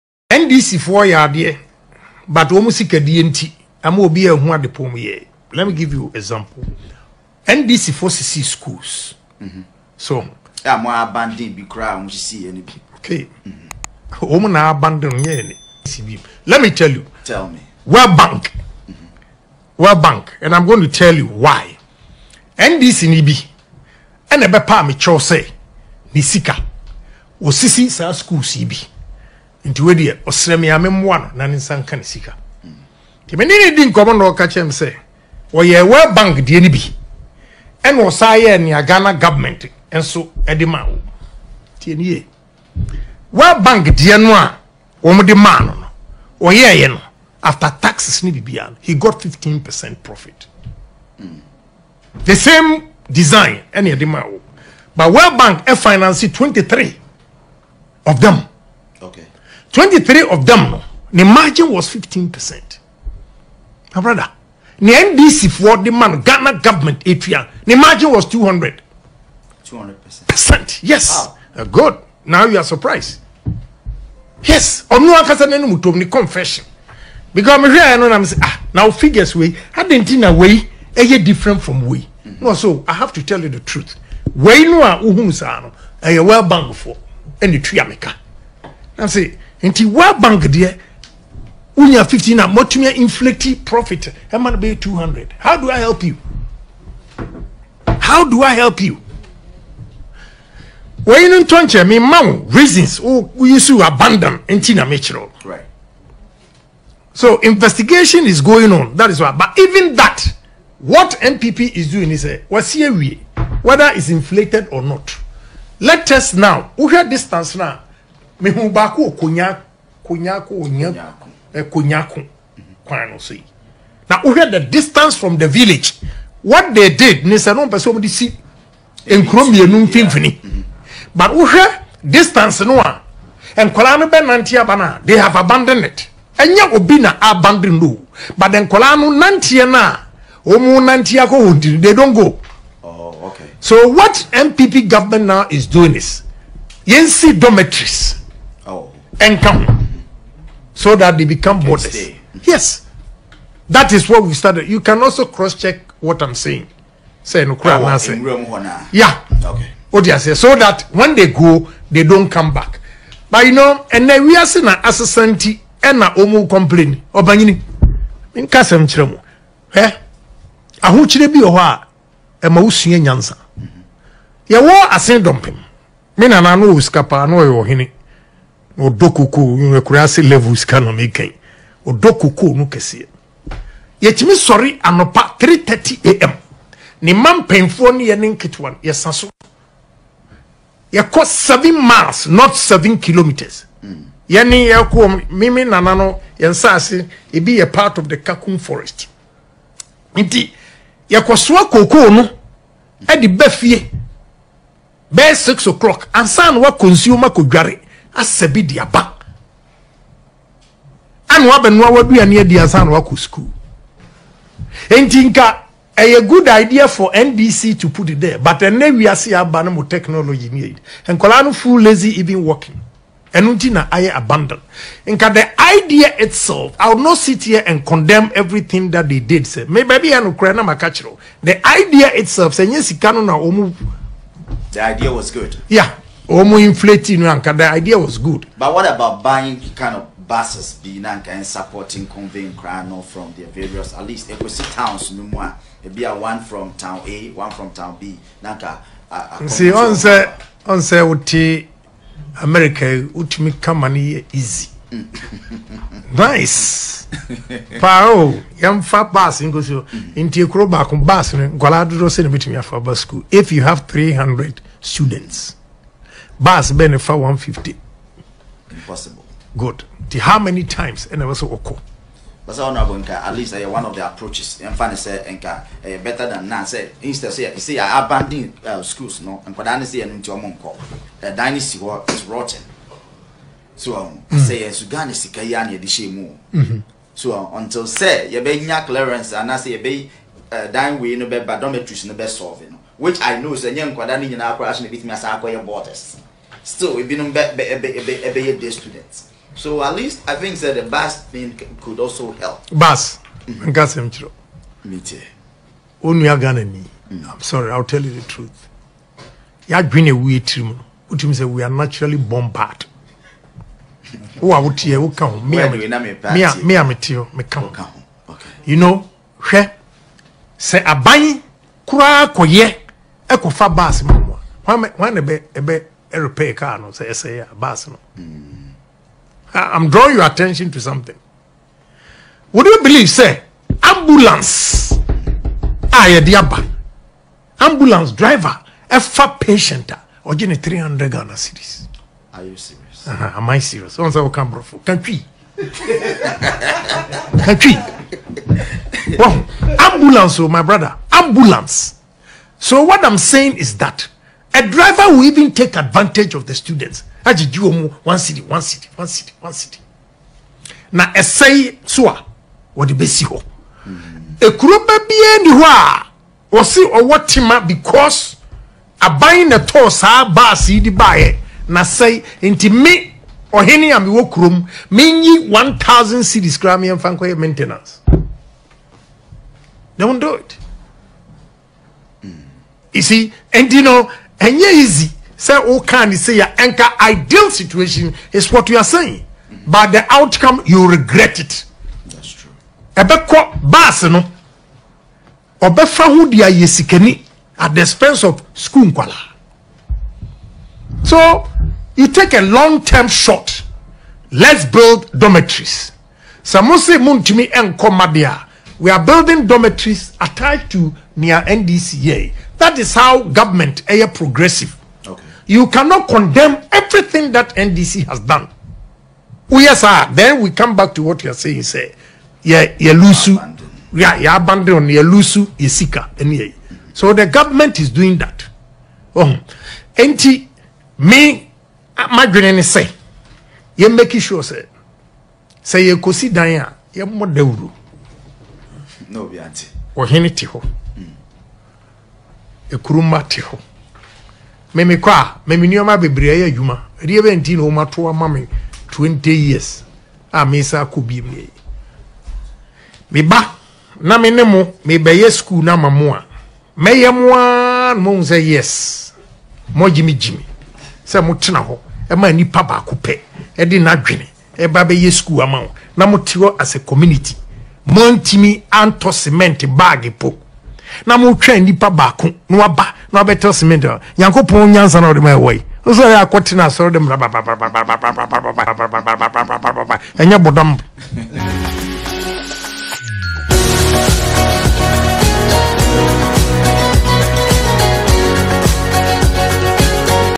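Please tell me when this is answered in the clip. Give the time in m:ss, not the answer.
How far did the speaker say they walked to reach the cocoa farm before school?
3:10.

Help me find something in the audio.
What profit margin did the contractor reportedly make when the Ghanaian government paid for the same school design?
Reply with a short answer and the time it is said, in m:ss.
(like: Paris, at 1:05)
200%, at 1:08.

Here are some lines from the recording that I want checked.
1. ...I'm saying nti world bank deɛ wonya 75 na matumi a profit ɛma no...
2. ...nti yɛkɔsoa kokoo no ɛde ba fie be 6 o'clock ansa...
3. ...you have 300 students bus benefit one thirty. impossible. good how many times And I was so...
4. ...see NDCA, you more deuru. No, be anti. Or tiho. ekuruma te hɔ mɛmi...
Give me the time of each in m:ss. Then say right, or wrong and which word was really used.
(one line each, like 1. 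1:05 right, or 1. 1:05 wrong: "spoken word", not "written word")
1. 1:28 wrong: "15", not "75"
2. 3:20 right
3. 4:23 wrong: "fifty", not "thirty"
4. 7:16 wrong: "Diana", not "NDCA".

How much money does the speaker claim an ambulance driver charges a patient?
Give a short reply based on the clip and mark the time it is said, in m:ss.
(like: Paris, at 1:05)
300 Ghana cedis, at 5:40.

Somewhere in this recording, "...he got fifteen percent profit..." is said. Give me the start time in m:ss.
0:48.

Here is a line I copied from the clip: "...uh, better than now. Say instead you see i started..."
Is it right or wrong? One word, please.
wrong.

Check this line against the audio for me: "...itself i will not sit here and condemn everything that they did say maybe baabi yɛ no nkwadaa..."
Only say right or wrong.
wrong.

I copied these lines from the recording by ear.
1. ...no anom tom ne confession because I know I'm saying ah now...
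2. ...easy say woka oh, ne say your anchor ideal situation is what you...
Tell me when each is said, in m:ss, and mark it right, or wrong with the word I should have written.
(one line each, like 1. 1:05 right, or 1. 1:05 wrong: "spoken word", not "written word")
1. 1:15 right
2. 6:24 right.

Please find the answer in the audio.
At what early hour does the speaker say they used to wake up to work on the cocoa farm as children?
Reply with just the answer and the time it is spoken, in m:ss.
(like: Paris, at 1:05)
3:30 am, at 3:05.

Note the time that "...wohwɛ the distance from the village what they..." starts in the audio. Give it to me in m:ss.
2:04.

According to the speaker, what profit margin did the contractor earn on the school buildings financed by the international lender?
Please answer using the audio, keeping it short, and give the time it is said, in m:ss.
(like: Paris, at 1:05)
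15%, at 1:01.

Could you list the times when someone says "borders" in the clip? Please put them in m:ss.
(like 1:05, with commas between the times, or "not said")
2:31, 4:55.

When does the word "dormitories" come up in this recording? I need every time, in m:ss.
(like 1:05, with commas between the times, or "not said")
2:27, 4:51, 6:45, 6:49.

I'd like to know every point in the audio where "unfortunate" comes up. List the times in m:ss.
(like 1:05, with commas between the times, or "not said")
not said.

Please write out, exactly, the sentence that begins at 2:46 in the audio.
a omu complain obanyini In kasa kire eh ahokyire bi wɔ hɔ a ɛma wosua nyansa yɛwɔ asen dumpim.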